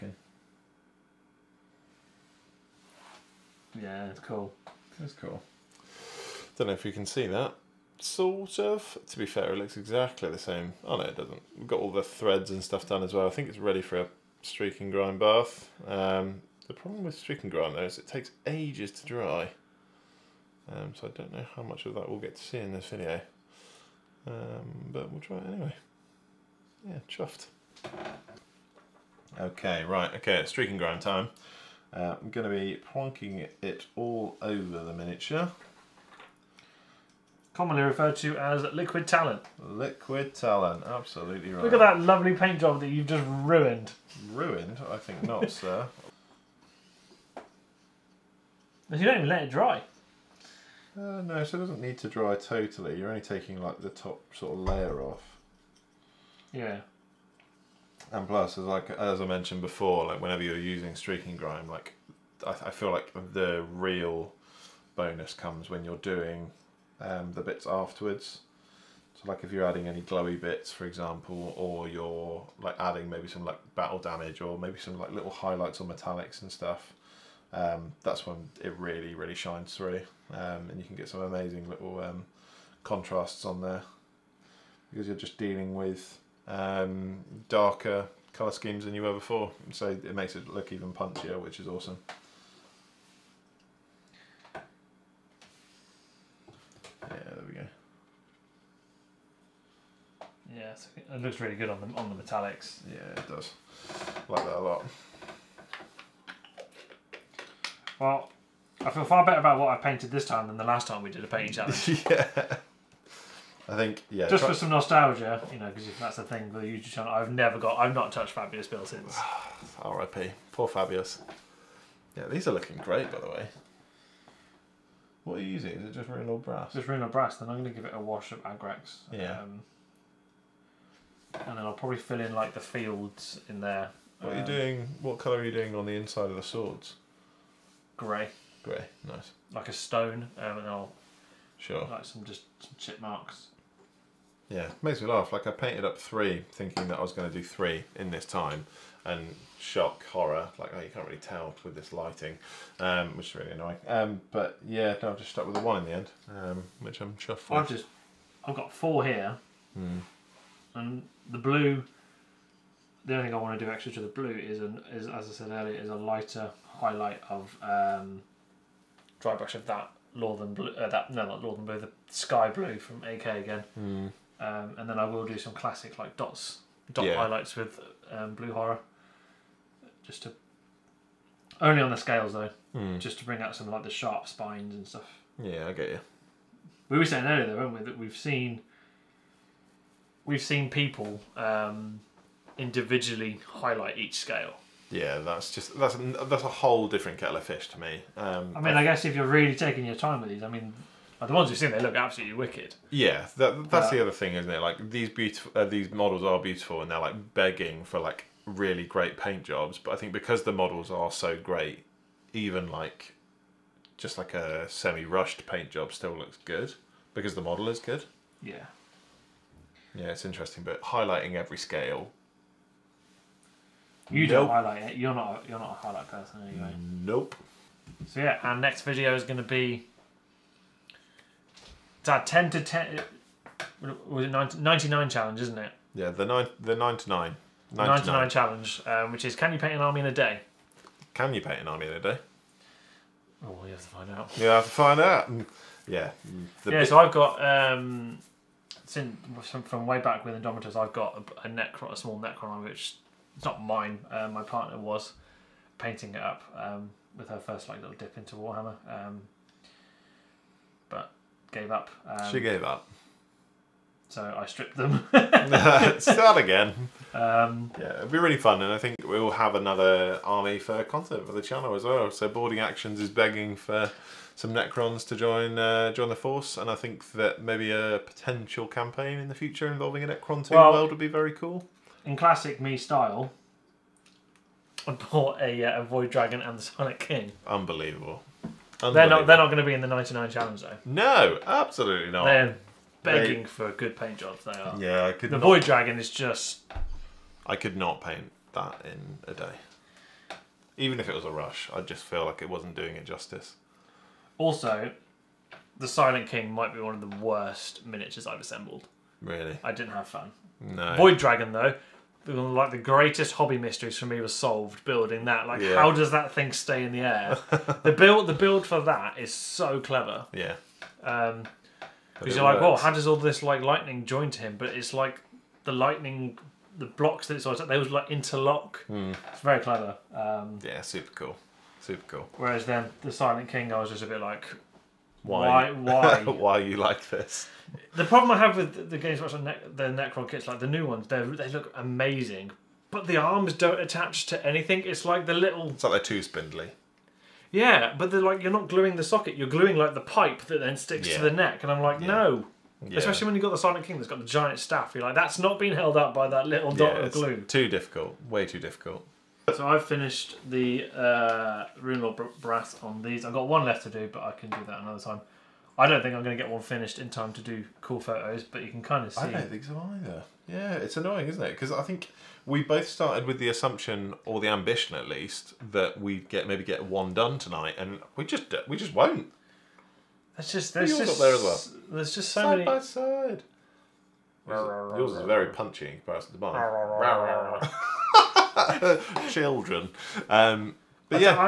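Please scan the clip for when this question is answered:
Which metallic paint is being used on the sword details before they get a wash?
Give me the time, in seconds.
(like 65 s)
126 s.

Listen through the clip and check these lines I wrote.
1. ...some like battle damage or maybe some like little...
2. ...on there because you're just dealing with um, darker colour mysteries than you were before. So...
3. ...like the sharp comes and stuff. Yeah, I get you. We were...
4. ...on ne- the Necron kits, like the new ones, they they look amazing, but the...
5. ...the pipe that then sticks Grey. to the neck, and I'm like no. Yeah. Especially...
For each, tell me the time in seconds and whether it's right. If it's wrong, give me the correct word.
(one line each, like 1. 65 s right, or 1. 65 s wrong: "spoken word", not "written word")
1. 73 s right
2. 83 s wrong: "schemes", not "mysteries"
3. 183 s wrong: "spines", not "comes"
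4. 339 s right
5. 349 s wrong: "Yeah", not "Grey".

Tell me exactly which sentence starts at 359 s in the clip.
So I've finished the uh, Rune Lord brass on these.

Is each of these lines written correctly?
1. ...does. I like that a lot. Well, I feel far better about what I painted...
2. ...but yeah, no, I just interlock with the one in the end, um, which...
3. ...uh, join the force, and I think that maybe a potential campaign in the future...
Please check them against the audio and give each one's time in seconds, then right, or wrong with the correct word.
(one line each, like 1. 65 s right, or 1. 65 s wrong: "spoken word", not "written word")
1. 103 s right
2. 154 s wrong: "stuck", not "interlock"
3. 275 s right.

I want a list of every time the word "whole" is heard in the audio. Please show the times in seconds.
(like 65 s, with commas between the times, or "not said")
196 s.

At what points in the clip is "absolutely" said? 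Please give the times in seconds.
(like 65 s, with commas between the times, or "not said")
40 s, 201 s, 291 s.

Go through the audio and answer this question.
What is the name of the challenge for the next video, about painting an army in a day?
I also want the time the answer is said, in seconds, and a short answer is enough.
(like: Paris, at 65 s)
Nine to Nine, at 236 s.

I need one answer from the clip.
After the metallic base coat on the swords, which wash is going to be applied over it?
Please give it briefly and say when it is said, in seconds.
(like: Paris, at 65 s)
Agrax, at 128 s.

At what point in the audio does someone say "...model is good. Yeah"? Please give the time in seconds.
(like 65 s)
217 s.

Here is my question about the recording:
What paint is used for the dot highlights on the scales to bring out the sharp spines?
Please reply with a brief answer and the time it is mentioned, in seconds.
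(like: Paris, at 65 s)
Blue Horror, at 178 s.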